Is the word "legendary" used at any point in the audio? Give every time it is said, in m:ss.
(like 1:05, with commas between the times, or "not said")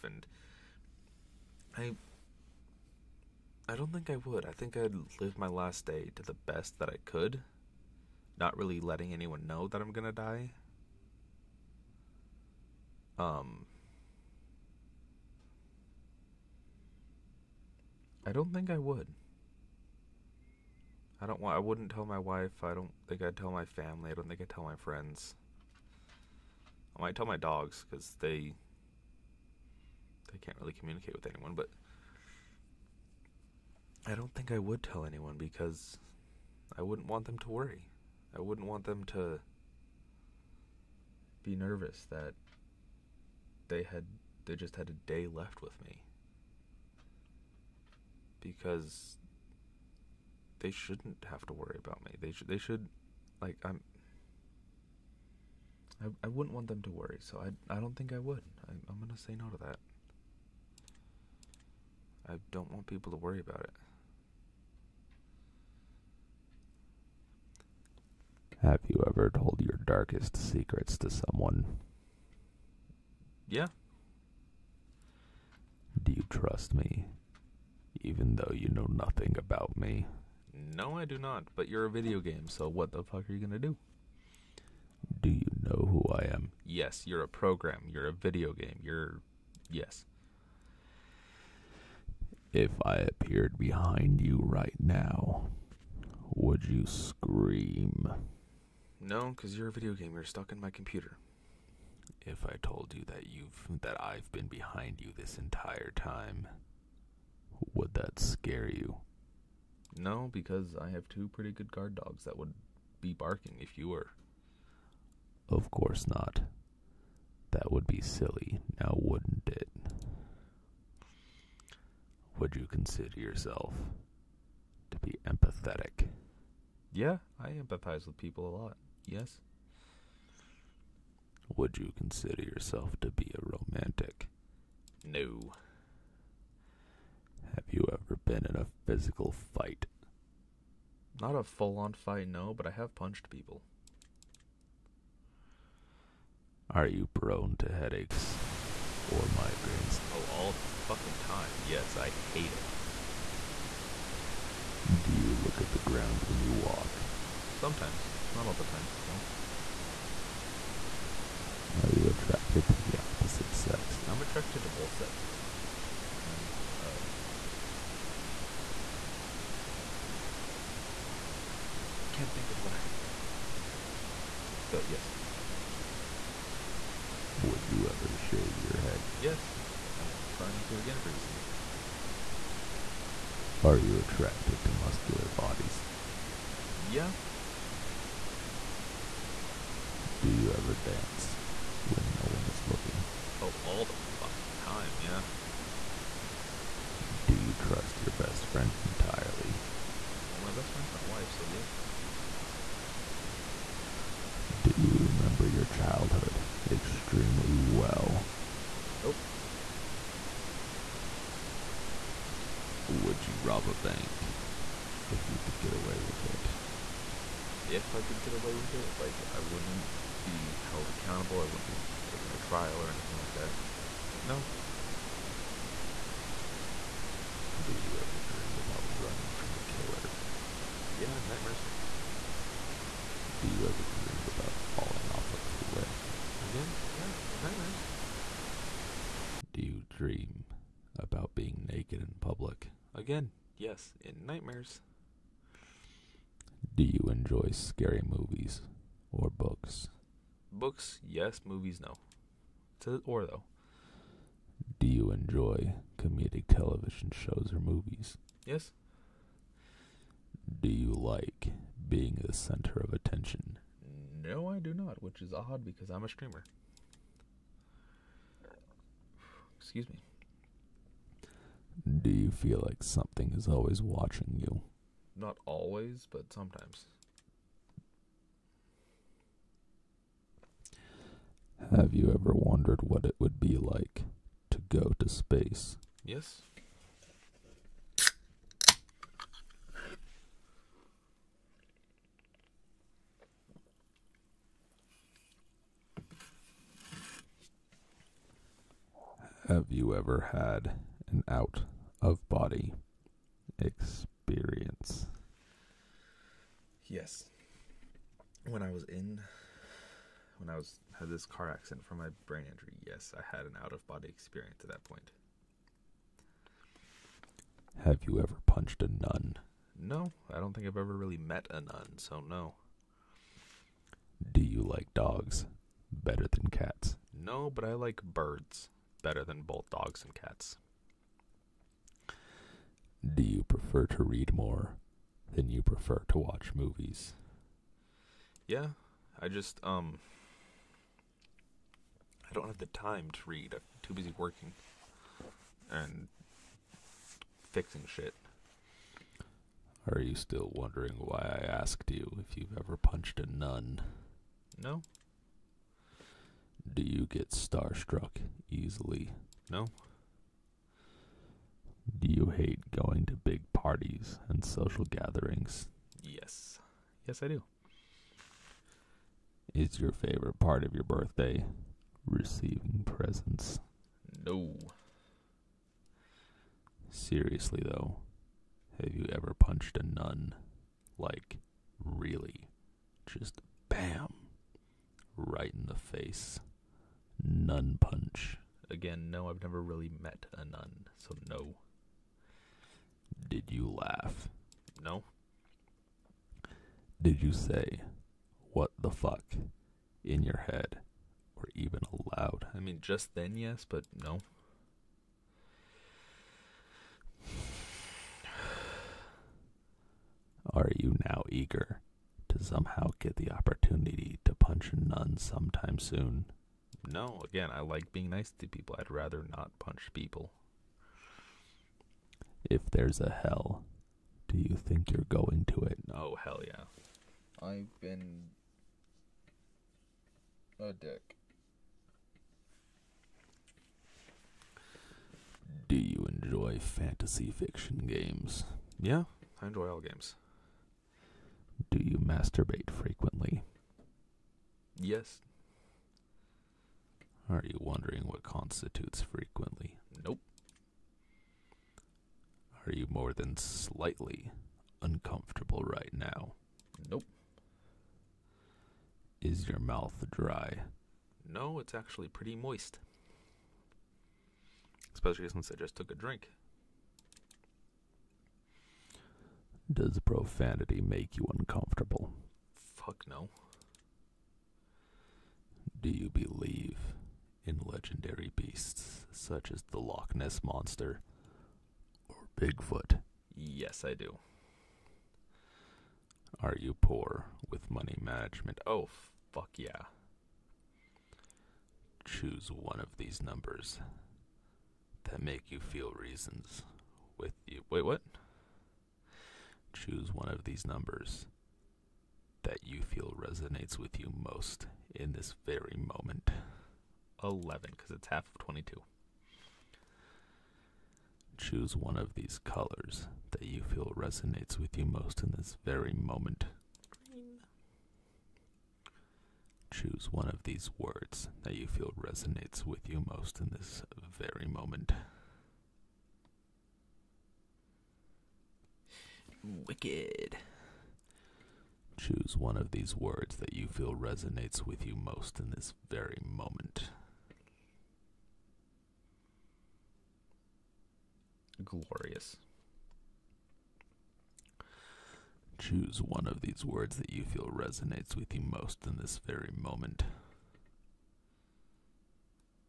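7:57.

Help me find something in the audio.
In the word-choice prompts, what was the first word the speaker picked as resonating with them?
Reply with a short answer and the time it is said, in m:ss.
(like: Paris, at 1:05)
Wicked, at 8:49.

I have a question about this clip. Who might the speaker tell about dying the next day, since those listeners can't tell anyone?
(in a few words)
my dogs.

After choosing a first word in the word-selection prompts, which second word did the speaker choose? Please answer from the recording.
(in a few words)
Glorious.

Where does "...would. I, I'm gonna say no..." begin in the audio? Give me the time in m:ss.
0:58.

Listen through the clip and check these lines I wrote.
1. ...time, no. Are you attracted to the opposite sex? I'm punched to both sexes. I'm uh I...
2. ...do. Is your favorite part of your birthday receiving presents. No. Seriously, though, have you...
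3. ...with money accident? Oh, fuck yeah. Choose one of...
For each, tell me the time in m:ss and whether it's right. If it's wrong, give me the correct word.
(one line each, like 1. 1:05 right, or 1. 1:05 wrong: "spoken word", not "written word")
1. 2:38 wrong: "attracted", not "punched"
2. 6:07 right
3. 8:07 wrong: "management", not "accident".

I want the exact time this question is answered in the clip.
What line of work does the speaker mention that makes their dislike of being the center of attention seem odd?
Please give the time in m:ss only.
4:26.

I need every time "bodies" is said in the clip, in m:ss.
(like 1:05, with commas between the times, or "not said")
3:05.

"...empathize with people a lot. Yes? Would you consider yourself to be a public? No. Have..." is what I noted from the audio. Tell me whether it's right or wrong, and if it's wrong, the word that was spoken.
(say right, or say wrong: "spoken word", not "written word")
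wrong: "romantic", not "public".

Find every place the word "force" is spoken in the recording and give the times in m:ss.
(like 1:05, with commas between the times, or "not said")
not said.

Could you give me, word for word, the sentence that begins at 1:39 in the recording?
No, because you're a video game.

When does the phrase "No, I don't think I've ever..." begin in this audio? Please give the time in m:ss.
5:19.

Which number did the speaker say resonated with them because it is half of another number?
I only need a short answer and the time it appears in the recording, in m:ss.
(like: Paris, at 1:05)
11, at 8:27.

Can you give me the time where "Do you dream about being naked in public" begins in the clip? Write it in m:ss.
3:59.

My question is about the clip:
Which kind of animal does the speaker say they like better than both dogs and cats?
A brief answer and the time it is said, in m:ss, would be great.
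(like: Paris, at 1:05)
birds, at 5:28.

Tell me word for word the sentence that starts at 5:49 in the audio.
Are you still wondering why I asked you if you've ever punched a nun?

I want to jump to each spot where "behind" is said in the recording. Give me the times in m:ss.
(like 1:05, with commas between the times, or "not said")
1:33, 1:44.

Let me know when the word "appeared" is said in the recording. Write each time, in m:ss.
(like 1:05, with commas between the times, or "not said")
1:32.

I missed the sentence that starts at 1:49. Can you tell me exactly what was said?
No, because I have two pretty good guard dogs that would be barking if you were.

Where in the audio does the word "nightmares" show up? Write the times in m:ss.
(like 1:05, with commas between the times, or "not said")
3:51, 3:57, 4:04.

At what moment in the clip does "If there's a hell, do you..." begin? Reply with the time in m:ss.
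7:02.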